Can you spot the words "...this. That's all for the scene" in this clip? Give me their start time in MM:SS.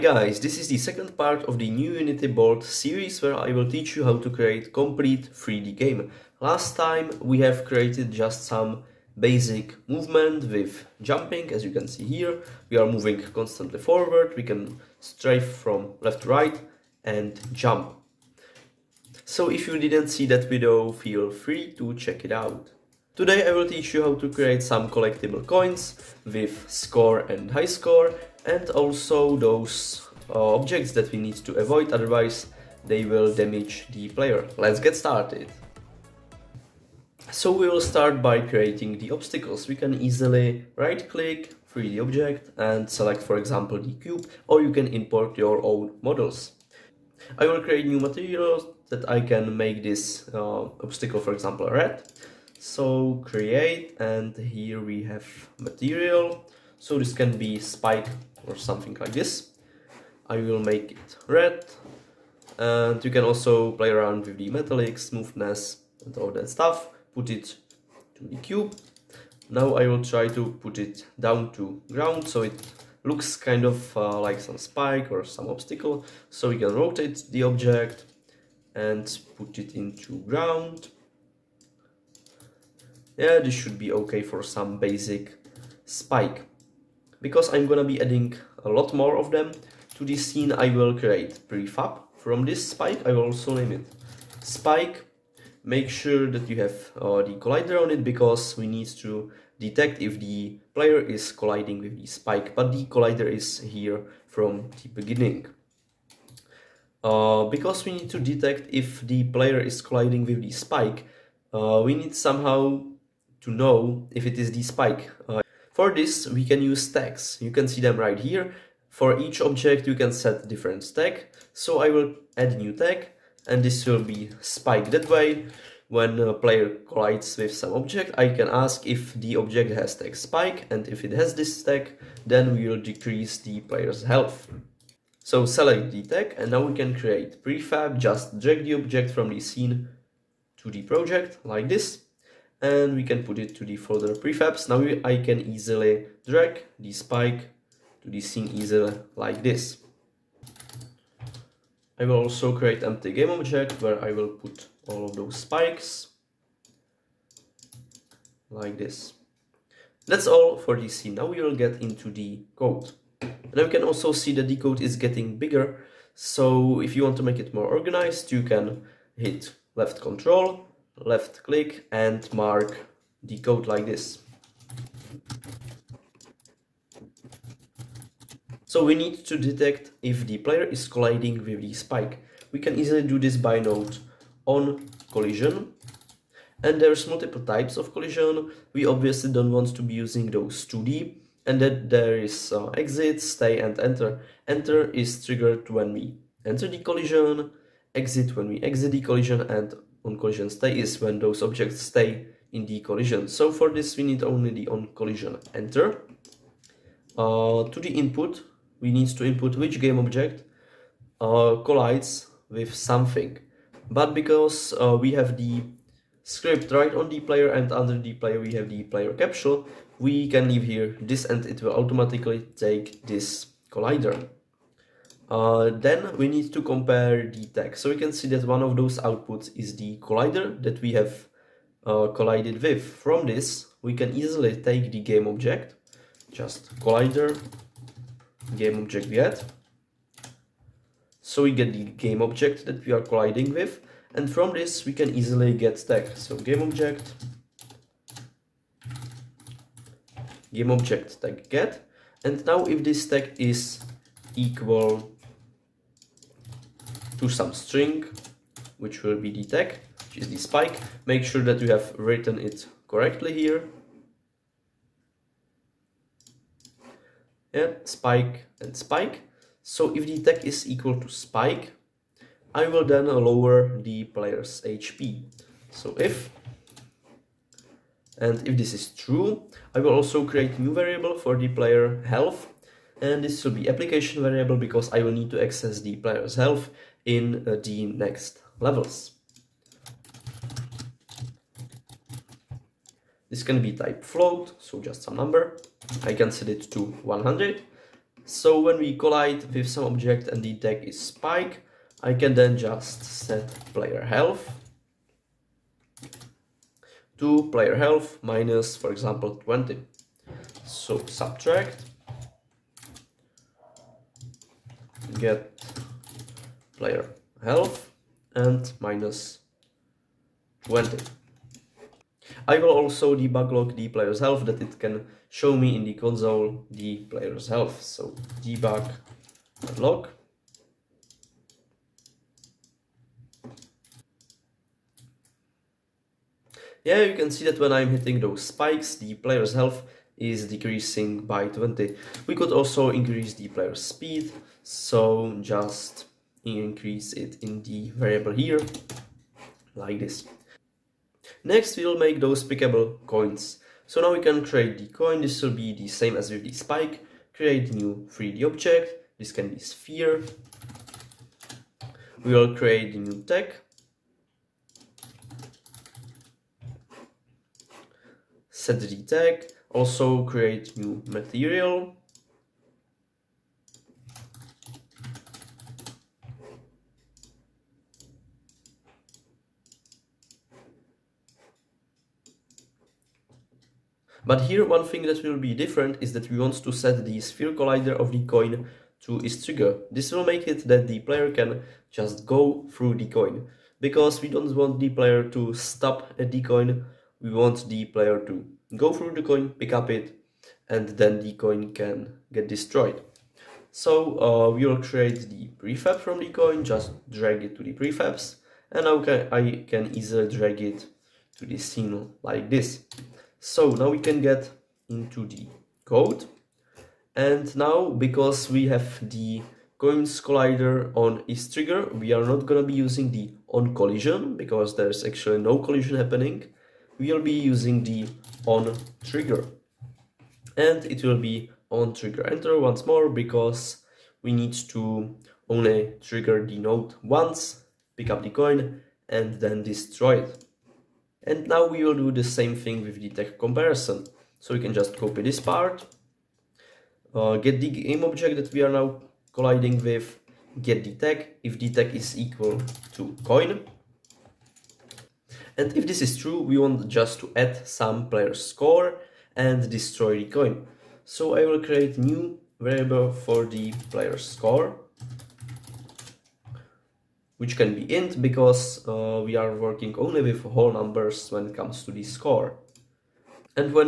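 02:38.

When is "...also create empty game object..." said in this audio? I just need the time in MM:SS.
02:32.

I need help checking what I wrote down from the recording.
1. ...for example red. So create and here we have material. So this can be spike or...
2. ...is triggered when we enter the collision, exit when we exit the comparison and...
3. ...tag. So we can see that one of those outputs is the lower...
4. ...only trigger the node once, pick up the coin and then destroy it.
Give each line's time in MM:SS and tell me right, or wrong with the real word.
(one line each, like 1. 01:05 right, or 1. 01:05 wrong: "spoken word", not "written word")
1. 00:51 right
2. 03:14 wrong: "collision", not "comparison"
3. 03:47 wrong: "collider", not "lower"
4. 07:15 right.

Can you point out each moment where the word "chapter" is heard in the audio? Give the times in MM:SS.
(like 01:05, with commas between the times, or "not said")
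not said.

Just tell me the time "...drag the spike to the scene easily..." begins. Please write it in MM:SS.
02:26.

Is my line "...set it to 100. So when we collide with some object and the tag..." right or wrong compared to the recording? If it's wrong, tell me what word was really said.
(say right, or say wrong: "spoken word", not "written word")
right.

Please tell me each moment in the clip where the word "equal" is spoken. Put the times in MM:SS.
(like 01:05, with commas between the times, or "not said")
04:14, 04:30, 07:32.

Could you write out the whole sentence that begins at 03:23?
So for this we need only the on collision enter.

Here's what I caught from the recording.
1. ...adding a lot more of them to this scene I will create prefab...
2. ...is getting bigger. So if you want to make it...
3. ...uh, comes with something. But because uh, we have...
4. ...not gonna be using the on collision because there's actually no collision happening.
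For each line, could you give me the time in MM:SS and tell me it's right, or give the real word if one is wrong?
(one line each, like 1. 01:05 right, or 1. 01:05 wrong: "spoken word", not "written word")
1. 01:28 right
2. 02:44 right
3. 03:31 wrong: "collides", not "comes"
4. 07:02 right.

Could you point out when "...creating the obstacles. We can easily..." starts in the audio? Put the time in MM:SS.
00:38.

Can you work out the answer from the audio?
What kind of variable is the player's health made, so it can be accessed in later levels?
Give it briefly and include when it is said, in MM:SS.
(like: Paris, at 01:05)
application variable, at 04:43.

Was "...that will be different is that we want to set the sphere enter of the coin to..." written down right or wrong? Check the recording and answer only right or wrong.
wrong.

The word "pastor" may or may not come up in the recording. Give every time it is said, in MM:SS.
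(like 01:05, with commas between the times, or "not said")
not said.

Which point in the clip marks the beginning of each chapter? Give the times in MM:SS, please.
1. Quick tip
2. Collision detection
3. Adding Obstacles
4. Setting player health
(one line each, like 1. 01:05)
1. 02:42
2. 02:57
3. 00:36
4. 04:39.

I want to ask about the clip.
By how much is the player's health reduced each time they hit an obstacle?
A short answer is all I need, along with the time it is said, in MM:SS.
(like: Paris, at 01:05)
20, at 05:08.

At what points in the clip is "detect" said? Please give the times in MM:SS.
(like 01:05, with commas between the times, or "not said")
01:39, 01:48, 02:59.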